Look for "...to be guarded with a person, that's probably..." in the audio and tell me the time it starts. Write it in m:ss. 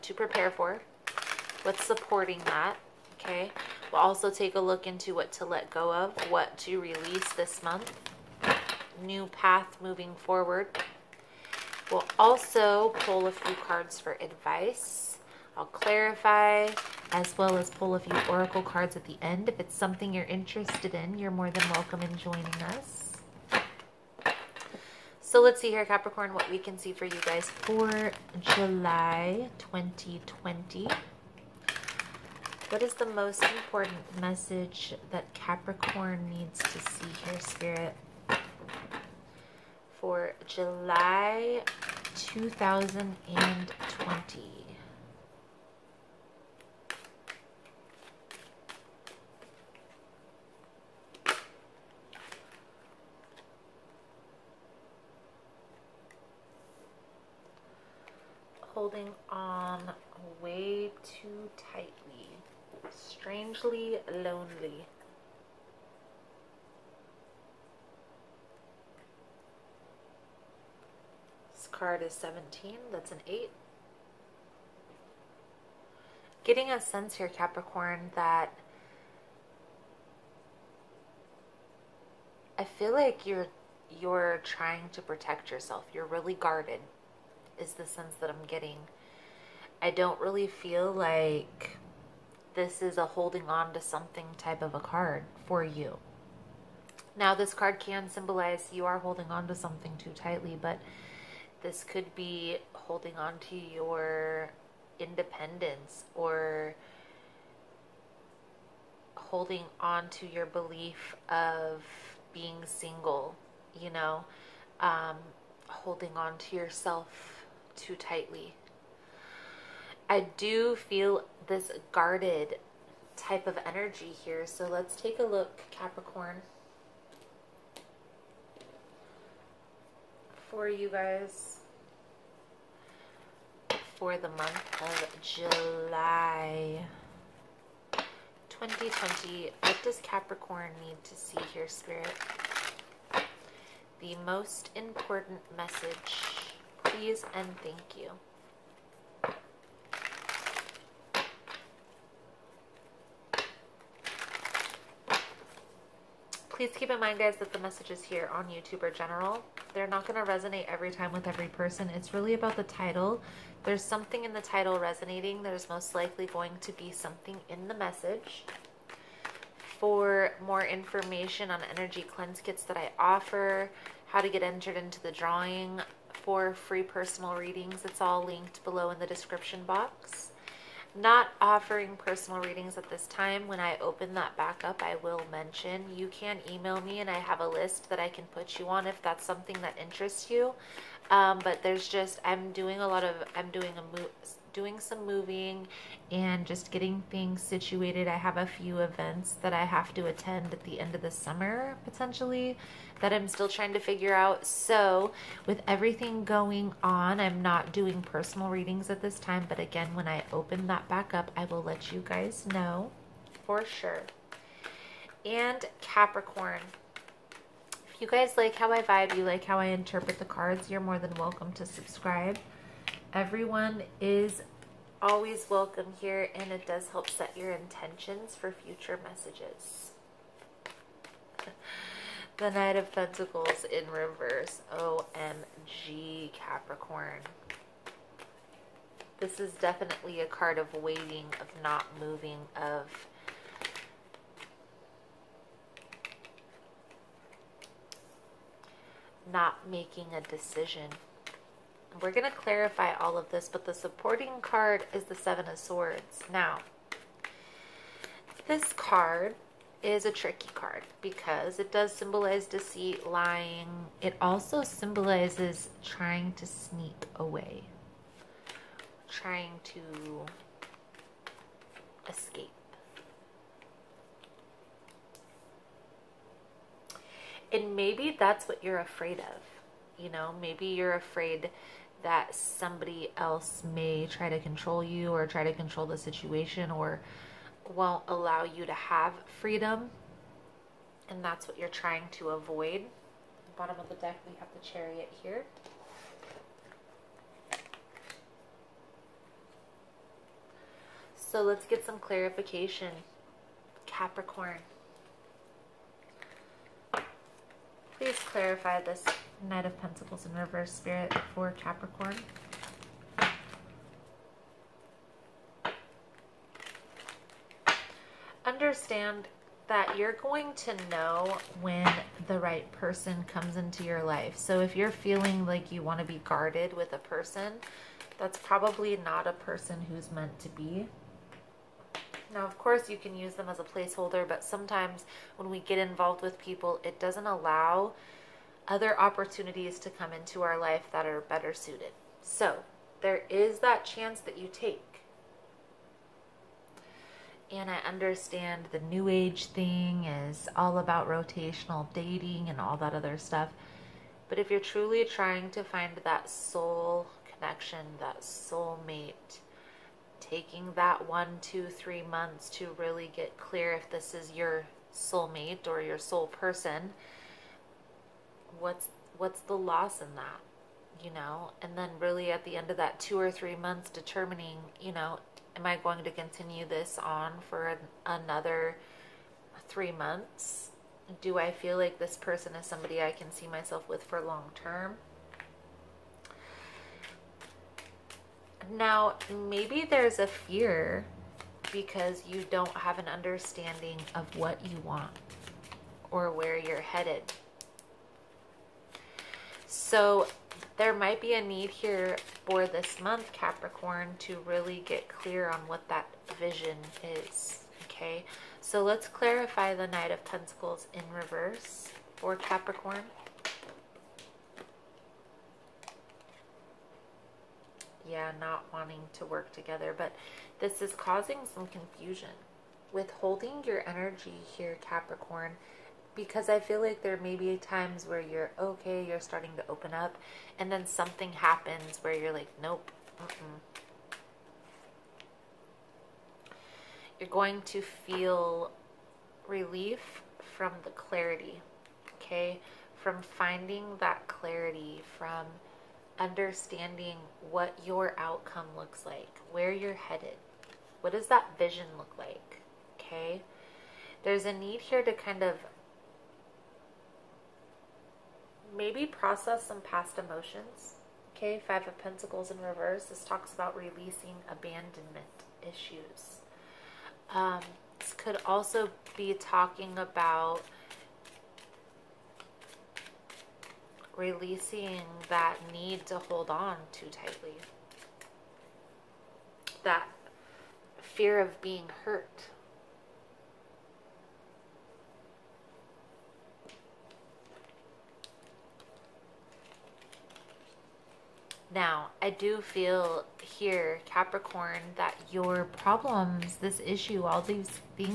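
5:25.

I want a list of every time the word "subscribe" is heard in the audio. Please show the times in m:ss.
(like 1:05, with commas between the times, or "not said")
3:41.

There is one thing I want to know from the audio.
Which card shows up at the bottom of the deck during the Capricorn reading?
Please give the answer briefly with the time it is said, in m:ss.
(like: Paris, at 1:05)
The Chariot, at 4:54.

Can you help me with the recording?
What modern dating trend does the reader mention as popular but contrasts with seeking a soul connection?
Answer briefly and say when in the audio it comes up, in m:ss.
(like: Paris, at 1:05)
Rotational dating, at 5:51.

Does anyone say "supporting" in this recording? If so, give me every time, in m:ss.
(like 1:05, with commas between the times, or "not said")
0:01, 4:13.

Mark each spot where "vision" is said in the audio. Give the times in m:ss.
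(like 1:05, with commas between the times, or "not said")
6:46, 7:31.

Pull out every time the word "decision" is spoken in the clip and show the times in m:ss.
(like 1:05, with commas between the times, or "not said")
4:10.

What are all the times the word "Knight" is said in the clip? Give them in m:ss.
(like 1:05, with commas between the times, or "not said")
3:52, 5:09, 6:49.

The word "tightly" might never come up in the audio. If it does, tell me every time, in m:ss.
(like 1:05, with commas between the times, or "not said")
1:01, 1:40, 1:57, 7:57.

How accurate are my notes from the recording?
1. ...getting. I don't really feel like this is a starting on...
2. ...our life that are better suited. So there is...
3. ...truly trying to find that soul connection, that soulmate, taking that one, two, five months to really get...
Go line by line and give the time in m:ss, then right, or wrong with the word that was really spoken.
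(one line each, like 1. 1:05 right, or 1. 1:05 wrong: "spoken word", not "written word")
1. 1:28 wrong: "holding", not "starting"
2. 5:40 right
3. 5:54 wrong: "three", not "five".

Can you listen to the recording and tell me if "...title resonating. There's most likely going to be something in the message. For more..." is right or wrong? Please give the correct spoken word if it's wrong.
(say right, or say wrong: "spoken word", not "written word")
right.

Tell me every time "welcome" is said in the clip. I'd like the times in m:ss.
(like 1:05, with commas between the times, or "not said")
0:21, 3:41, 3:45.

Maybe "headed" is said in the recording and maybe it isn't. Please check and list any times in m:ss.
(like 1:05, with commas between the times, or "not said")
6:36, 7:30.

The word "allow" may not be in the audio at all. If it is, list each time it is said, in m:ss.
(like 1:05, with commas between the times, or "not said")
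4:48, 5:37.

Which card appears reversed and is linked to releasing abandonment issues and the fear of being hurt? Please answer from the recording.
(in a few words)
Five of Pentacles.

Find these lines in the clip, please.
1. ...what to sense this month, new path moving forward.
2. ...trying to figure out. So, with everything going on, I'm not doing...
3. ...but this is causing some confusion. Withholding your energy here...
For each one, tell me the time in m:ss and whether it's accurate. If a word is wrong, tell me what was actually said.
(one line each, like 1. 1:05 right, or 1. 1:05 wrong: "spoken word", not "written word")
1. 0:06 wrong: "release", not "sense"
2. 3:23 right
3. 6:59 right.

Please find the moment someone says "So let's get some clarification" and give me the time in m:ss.
5:01.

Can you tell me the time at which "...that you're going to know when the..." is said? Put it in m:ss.
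5:19.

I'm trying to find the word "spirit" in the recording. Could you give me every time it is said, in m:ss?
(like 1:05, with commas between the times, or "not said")
0:37, 2:21, 5:10.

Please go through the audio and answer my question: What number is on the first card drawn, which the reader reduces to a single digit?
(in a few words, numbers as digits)
17.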